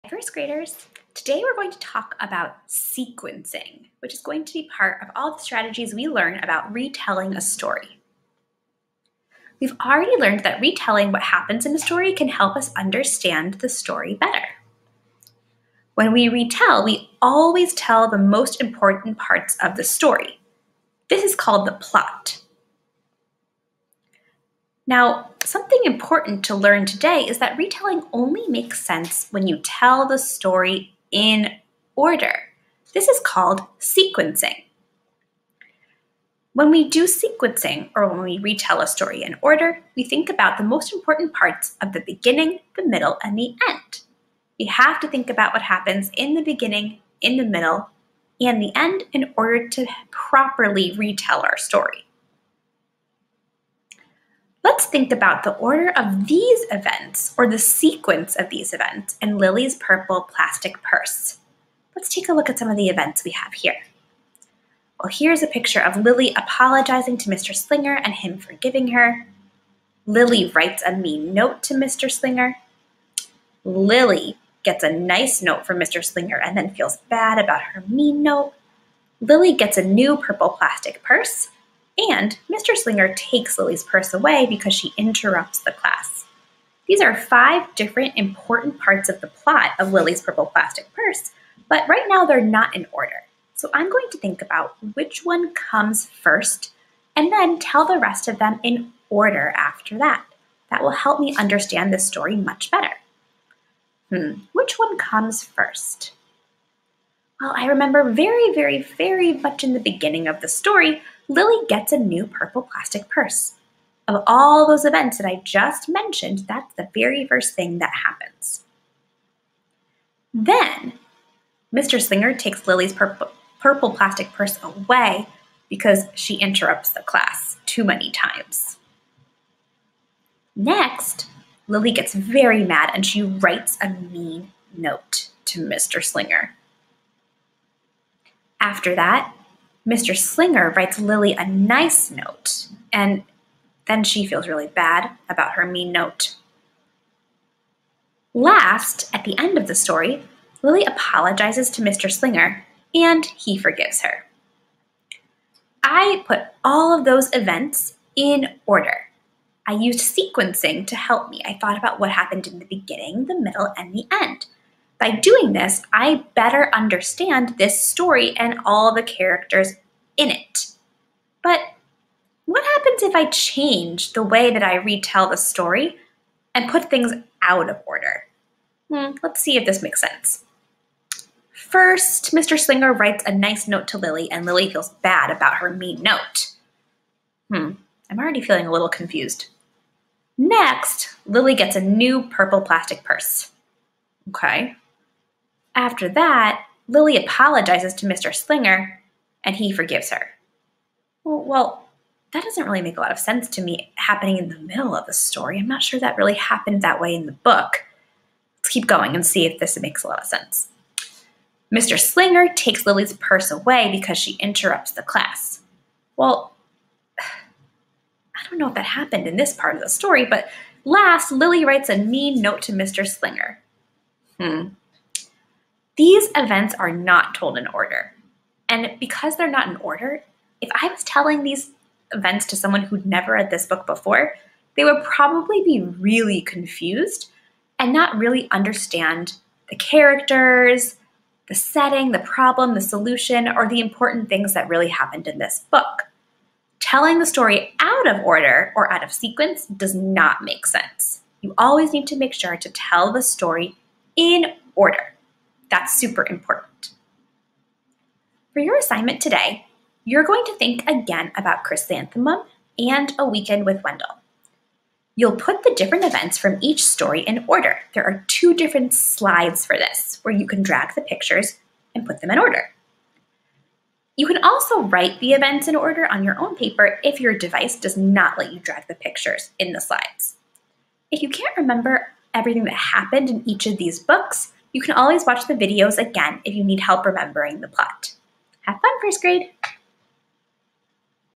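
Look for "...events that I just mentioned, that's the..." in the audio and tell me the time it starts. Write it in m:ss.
1:54.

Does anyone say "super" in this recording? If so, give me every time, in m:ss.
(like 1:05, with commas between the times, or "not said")
4:15.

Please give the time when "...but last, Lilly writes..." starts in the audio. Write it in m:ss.
3:40.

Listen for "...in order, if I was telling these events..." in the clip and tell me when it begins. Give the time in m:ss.
3:49.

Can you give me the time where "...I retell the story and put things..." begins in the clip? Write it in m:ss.
2:54.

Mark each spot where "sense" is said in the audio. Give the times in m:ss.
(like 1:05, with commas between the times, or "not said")
0:28, 3:00, 3:23, 3:30, 4:10.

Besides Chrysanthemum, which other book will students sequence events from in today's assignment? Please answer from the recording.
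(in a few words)
A Weekend with Wendell.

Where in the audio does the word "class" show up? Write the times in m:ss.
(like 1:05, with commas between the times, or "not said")
1:25, 2:07, 3:35.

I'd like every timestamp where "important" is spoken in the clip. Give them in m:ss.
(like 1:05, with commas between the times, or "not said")
0:18, 0:25, 0:40, 1:28, 4:03, 4:16.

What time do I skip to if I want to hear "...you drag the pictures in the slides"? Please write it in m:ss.
4:38.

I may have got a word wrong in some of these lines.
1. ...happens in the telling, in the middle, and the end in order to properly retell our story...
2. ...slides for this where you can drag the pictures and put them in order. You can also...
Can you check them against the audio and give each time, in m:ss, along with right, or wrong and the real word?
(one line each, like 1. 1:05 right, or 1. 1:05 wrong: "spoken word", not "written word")
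1. 0:45 wrong: "beginning", not "telling"
2. 4:28 right.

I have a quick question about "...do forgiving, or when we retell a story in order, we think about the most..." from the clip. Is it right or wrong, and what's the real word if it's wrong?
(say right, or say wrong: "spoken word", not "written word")
wrong: "sequencing", not "forgiving".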